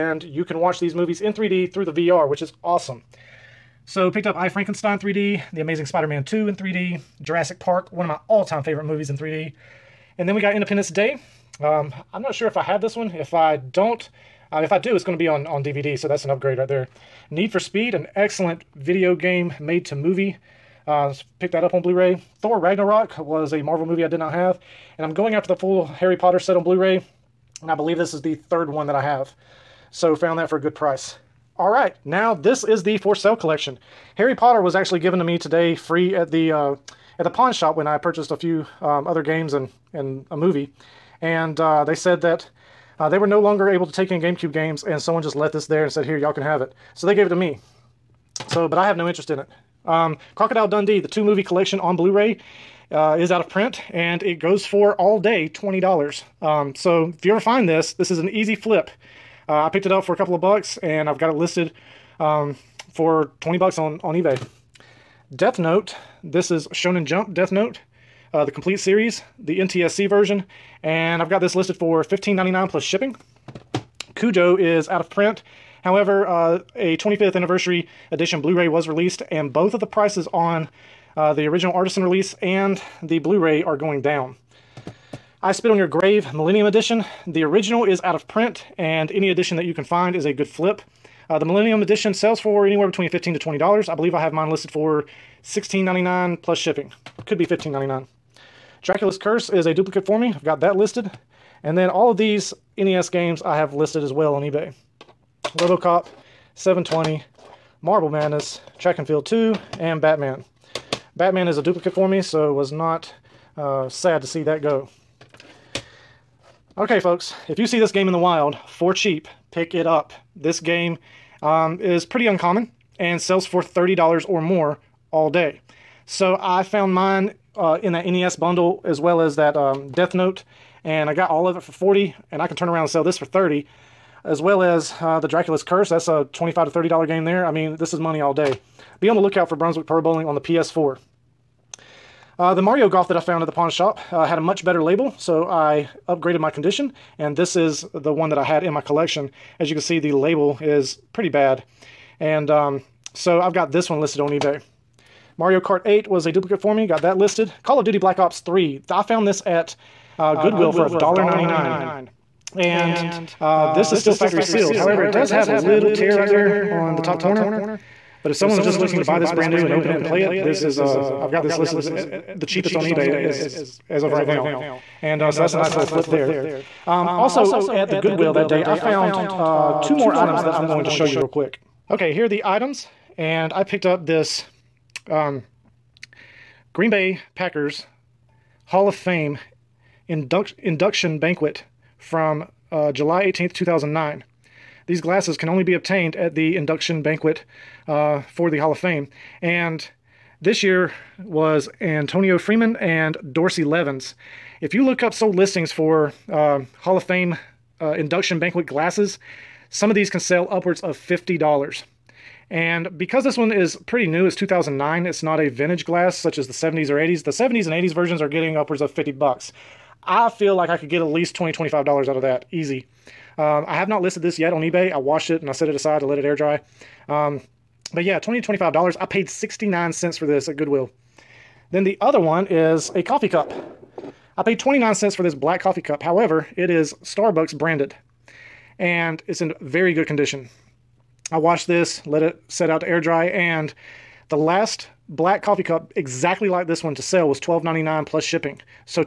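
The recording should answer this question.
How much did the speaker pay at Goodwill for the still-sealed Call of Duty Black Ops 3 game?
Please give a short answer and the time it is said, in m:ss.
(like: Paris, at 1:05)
$1.99, at 2:40.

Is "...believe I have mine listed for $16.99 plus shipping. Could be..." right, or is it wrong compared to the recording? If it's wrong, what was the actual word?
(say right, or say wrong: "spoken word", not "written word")
right.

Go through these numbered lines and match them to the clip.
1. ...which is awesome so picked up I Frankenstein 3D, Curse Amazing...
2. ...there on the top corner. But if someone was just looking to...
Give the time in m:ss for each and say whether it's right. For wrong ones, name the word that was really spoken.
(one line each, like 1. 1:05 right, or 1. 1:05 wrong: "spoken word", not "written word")
1. 0:02 wrong: "The", not "Curse"
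2. 2:46 right.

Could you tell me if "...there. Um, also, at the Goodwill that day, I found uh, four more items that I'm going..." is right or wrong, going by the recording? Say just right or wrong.
wrong.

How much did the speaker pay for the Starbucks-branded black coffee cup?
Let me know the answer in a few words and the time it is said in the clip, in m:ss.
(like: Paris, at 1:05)
29 cents, at 3:54.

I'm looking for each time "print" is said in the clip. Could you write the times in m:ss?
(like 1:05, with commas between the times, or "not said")
0:53, 1:15, 1:28.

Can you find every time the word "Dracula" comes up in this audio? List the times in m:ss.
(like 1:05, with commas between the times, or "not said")
1:38, 2:15.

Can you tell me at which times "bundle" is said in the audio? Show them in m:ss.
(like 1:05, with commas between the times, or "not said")
2:08.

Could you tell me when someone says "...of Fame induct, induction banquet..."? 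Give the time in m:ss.
3:08.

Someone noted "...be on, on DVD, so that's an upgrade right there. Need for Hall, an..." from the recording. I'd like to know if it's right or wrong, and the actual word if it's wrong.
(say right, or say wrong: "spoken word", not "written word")
wrong: "Speed", not "Hall".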